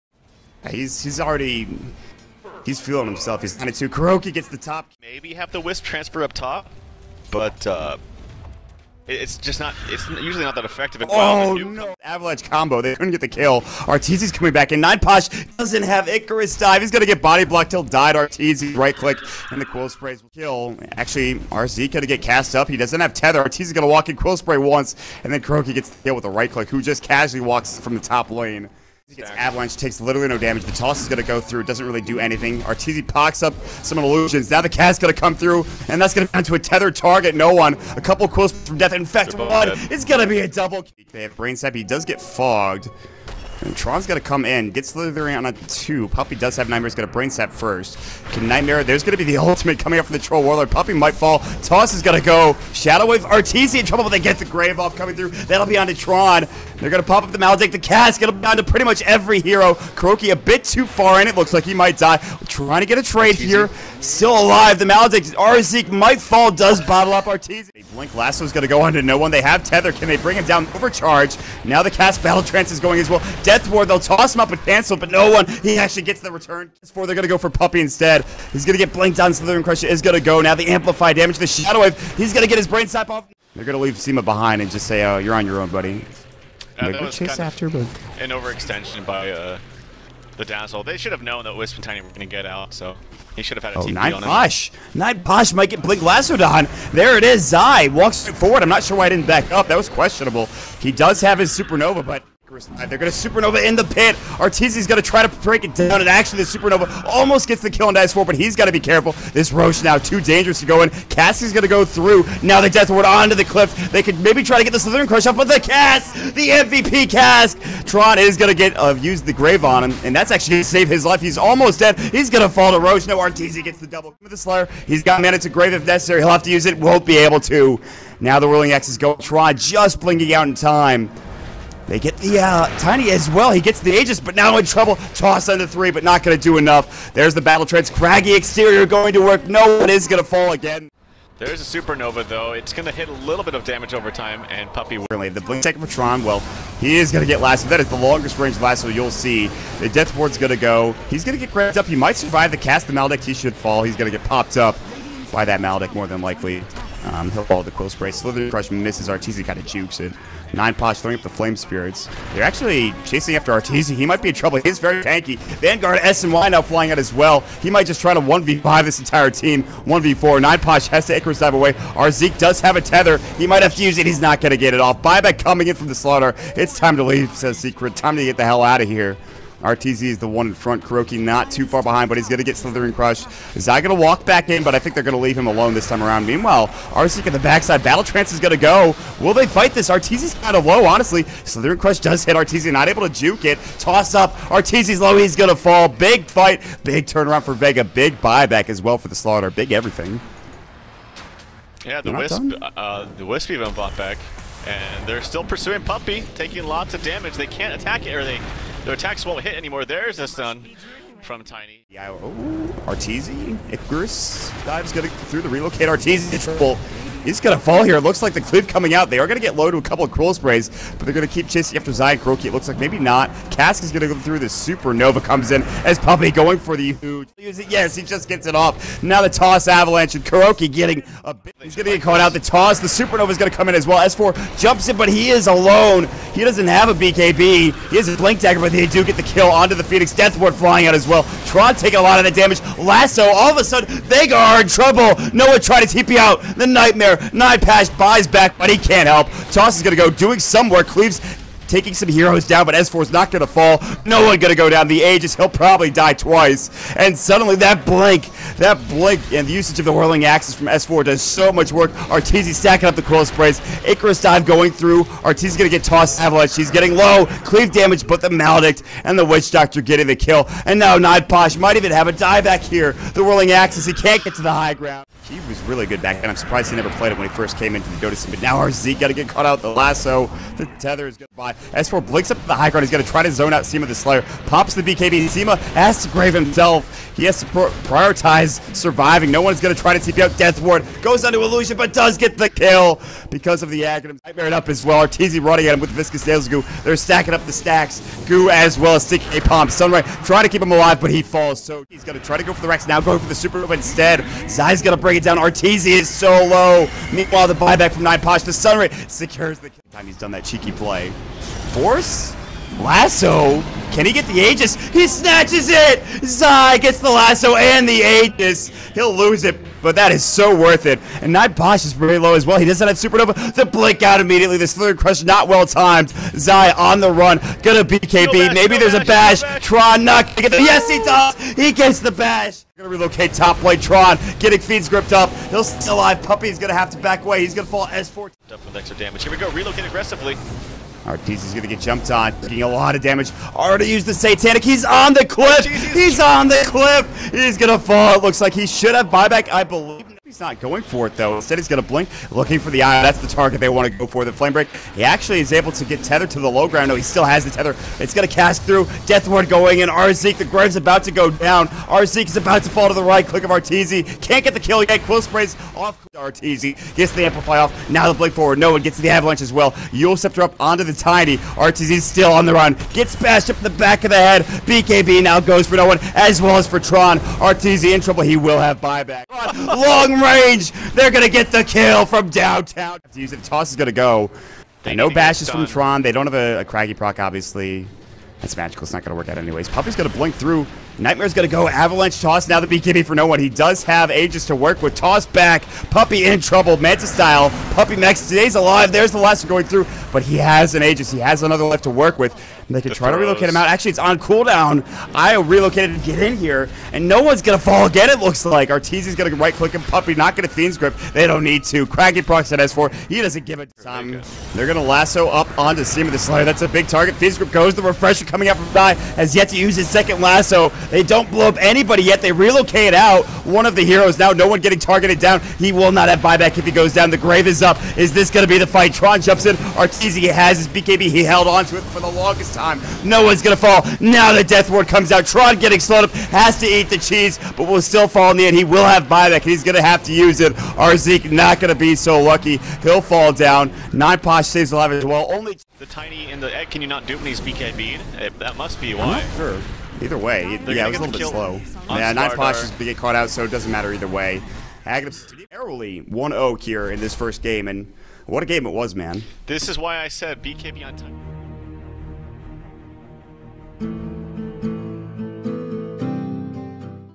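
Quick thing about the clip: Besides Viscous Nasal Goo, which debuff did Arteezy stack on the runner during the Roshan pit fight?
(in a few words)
Sticky Palm.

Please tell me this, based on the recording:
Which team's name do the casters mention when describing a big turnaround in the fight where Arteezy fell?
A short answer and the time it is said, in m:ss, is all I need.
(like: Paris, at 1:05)
Vega, at 3:17.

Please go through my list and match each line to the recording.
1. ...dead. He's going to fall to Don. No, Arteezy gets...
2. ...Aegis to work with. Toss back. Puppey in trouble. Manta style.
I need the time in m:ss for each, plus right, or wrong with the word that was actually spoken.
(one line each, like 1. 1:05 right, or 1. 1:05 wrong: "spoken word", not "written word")
1. 2:01 wrong: "Rosh", not "Don"
2. 6:34 right.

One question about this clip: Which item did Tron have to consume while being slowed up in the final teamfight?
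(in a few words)
cheese.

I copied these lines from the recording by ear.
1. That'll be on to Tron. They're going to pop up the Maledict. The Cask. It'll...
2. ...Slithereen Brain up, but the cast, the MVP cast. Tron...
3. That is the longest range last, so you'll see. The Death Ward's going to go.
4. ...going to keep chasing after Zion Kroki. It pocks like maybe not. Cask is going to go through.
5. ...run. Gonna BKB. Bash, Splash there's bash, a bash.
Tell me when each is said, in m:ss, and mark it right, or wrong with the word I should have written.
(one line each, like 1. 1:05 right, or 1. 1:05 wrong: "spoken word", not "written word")
1. 0:55 right
2. 1:54 wrong: "Crush", not "Brain"
3. 2:27 right
4. 3:41 wrong: "looks", not "pocks"
5. 5:27 wrong: "Maybe", not "Splash".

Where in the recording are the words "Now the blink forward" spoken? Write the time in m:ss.
6:07.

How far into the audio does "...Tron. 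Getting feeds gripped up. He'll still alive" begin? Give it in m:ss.
5:33.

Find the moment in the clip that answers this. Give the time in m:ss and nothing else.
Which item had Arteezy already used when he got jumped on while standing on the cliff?
5:44.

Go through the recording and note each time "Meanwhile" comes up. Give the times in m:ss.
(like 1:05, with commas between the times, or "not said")
3:06, 5:07.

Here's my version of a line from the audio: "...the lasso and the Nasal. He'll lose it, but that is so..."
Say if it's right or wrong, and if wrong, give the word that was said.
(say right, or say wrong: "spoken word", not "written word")
wrong: "Aegis", not "Nasal".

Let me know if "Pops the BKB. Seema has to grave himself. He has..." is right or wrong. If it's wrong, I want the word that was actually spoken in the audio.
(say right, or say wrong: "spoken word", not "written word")
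right.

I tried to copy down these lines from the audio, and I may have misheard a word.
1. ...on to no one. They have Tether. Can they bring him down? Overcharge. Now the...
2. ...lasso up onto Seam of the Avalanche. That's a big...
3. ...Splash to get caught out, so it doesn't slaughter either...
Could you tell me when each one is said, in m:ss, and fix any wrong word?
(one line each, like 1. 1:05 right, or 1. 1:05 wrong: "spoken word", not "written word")
1. 1:08 right
2. 6:54 wrong: "Slayer", not "Avalanche"
3. 7:32 wrong: "matter", not "slaughter".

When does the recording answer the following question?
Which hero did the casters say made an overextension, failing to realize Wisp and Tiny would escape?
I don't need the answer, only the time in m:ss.
1:30.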